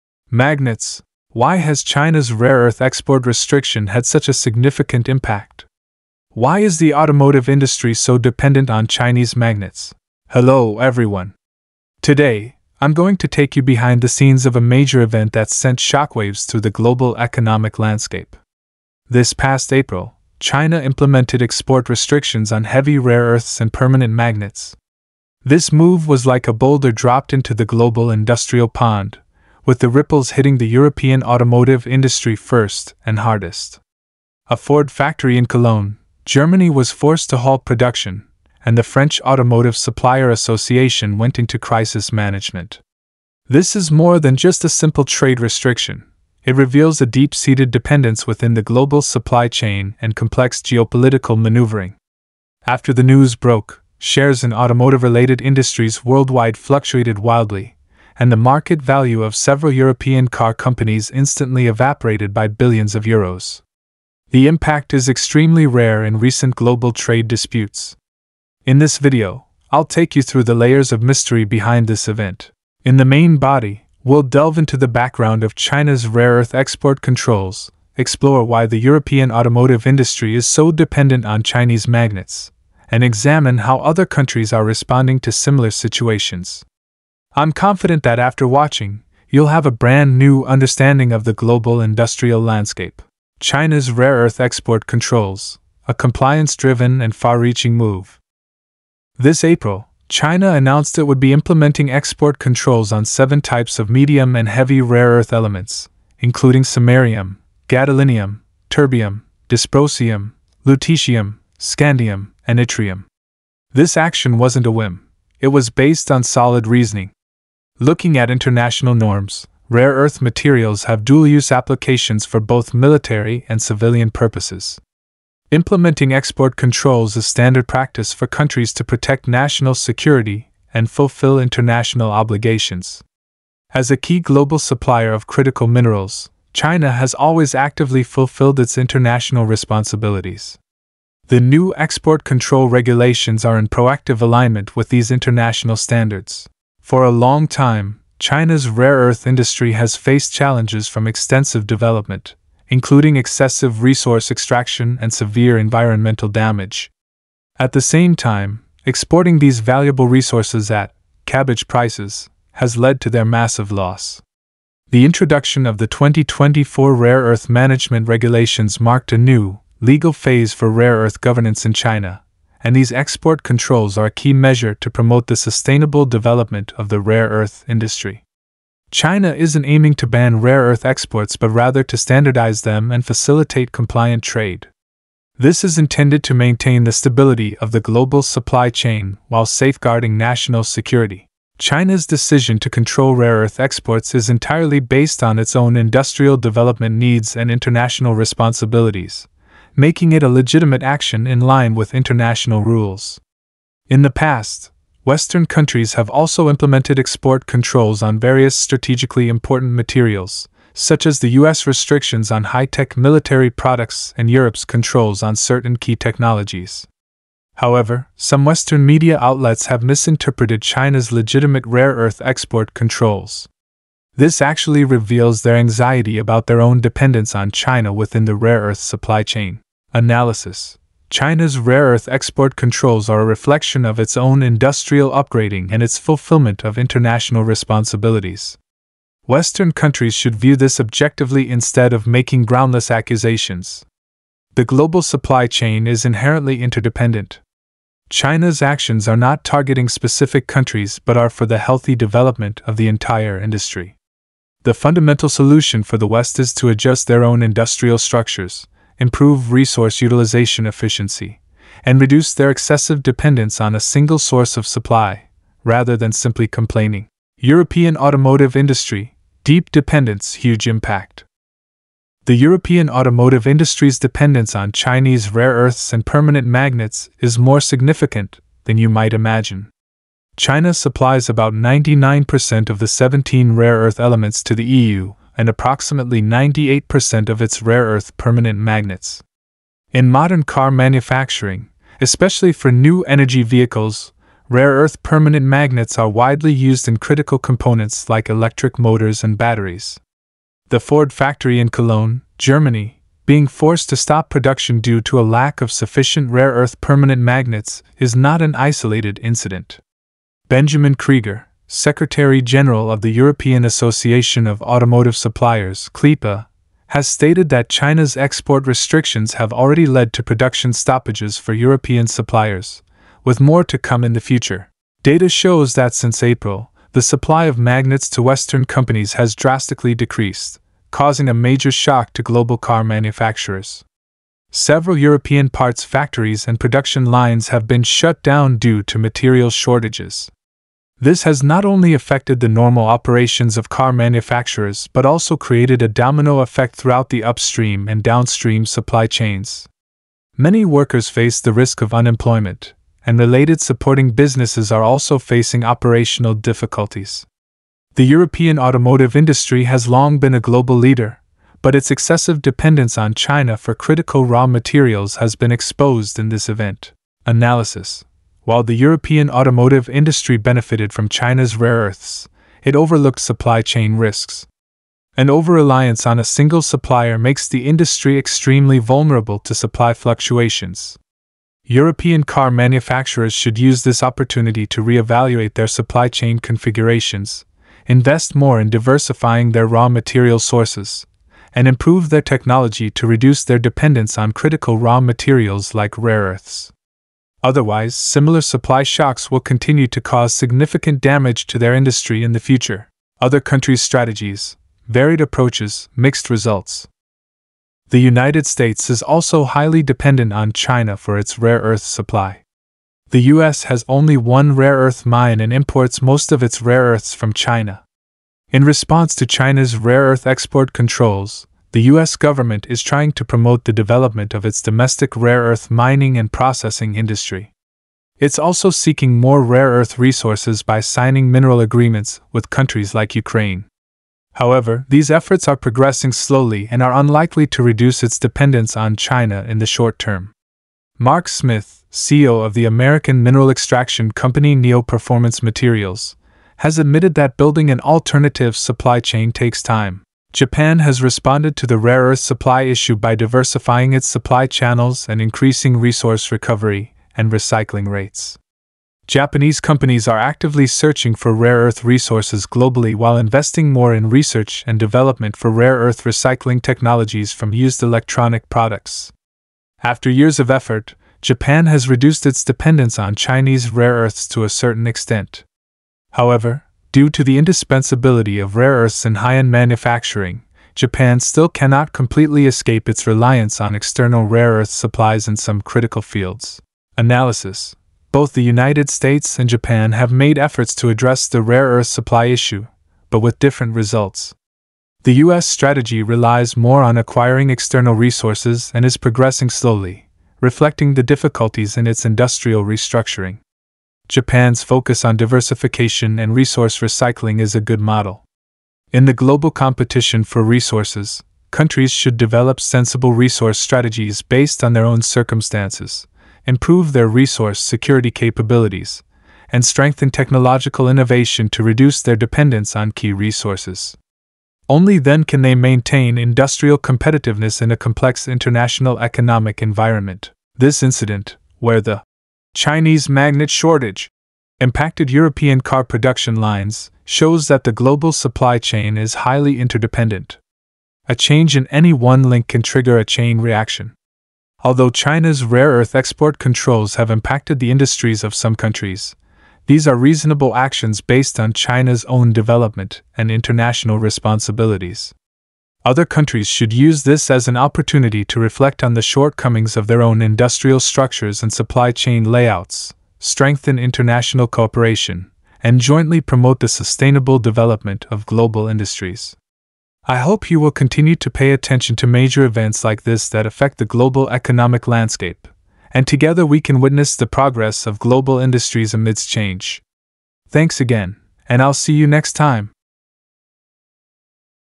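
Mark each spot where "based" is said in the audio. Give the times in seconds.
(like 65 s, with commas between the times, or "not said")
115 s, 194 s, 514 s, 550 s.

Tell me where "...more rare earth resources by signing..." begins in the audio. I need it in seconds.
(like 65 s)
429 s.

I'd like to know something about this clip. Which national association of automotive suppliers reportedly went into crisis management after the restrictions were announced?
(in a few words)
French Automotive Supplier Association.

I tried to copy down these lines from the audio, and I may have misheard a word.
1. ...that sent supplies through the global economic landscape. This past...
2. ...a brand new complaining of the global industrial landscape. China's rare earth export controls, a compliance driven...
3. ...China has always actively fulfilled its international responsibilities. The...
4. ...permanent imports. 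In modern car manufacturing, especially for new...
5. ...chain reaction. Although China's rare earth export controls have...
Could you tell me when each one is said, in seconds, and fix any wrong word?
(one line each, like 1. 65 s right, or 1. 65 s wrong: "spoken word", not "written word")
1. 15 s wrong: "shockwaves", not "supplies"
2. 89 s wrong: "understanding", not "complaining"
3. 136 s right
4. 288 s wrong: "magnets", not "imports"
5. 543 s right.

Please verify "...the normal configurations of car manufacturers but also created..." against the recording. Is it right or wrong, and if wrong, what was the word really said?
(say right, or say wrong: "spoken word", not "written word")
wrong: "operations", not "configurations".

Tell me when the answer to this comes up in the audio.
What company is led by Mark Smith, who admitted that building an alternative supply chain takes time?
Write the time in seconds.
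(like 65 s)
444 s.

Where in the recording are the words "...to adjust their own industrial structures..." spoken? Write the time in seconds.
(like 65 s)
256 s.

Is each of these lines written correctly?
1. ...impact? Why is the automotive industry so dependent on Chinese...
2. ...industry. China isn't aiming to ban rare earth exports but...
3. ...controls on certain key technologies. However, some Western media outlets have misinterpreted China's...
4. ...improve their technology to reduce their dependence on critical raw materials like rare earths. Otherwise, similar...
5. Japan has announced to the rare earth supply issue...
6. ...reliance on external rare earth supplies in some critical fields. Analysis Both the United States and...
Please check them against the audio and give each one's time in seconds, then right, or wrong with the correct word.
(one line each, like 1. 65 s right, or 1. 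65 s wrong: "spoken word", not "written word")
1. 5 s right
2. 177 s right
3. 214 s right
4. 391 s right
5. 450 s wrong: "responded", not "announced"
6. 483 s right.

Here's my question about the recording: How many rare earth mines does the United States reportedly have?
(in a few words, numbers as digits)
1.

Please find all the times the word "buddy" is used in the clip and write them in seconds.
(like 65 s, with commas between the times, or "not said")
not said.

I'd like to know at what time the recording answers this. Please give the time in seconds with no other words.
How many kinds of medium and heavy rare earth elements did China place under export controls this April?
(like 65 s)
103 s.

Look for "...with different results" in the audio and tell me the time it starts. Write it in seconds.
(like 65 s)
493 s.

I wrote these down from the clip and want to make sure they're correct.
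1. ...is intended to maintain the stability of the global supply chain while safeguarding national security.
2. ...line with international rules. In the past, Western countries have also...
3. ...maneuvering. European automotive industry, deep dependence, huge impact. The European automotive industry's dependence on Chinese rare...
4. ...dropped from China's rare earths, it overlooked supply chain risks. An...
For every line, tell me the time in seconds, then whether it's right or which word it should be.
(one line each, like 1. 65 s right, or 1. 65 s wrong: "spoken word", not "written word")
1. 185 s right
2. 201 s right
3. 266 s wrong: "complaining", not "maneuvering"
4. 370 s wrong: "benefited", not "dropped".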